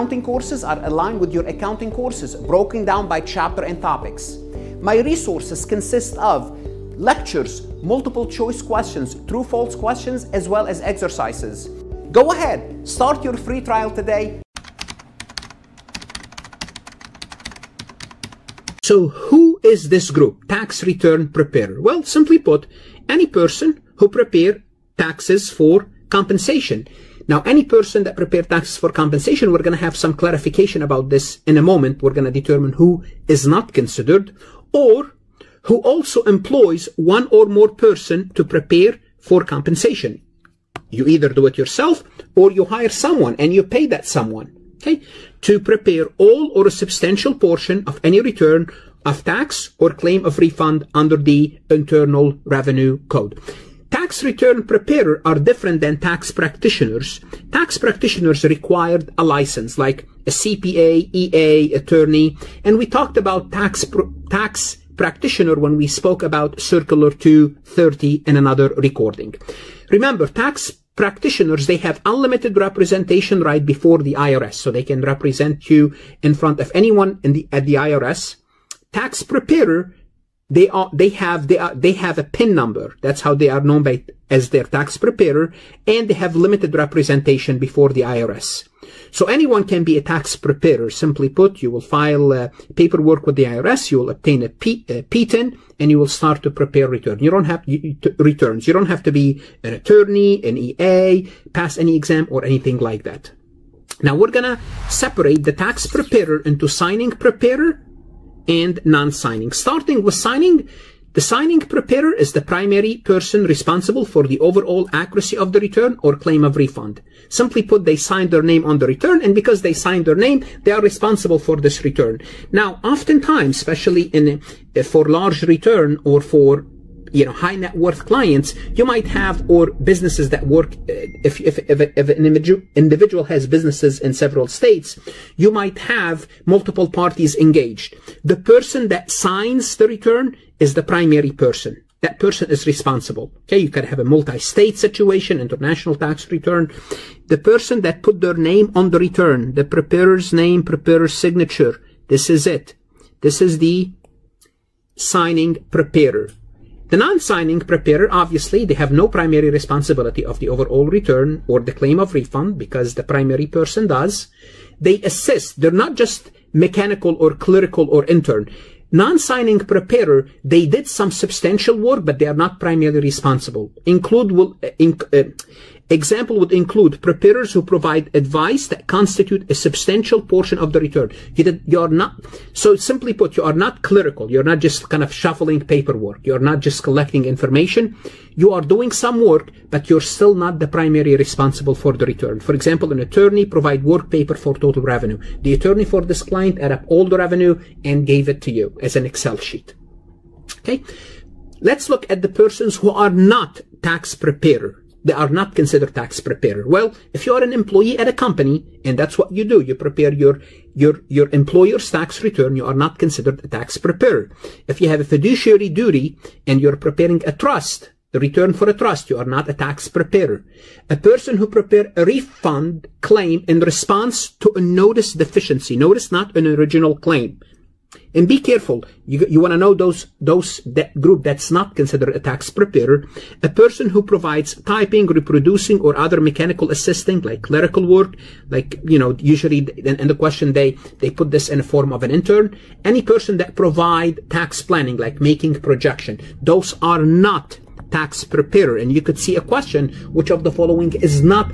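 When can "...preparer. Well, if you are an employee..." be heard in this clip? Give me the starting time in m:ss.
3:26.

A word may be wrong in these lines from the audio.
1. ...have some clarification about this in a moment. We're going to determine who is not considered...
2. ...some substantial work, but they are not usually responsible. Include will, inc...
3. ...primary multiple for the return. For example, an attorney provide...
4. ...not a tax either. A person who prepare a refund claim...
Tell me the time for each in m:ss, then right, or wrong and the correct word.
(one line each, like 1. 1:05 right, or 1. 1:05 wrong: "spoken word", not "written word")
1. 0:29 right
2. 2:50 wrong: "primarily", not "usually"
3. 3:10 wrong: "responsible", not "multiple"
4. 3:39 wrong: "preparer", not "either".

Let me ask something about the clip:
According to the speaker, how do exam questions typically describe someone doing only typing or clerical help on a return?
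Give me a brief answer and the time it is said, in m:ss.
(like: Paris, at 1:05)
An intern, at 4:02.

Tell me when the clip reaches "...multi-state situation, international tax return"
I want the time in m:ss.
2:24.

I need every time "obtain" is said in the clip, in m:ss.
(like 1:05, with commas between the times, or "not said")
1:34.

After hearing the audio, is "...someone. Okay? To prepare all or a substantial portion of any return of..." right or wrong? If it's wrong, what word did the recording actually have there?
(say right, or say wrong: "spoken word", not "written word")
right.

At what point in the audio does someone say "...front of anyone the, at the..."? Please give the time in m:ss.
1:16.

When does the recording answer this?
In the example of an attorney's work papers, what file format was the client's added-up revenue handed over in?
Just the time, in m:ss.
3:19.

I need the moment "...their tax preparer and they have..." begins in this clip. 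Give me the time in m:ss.
1:24.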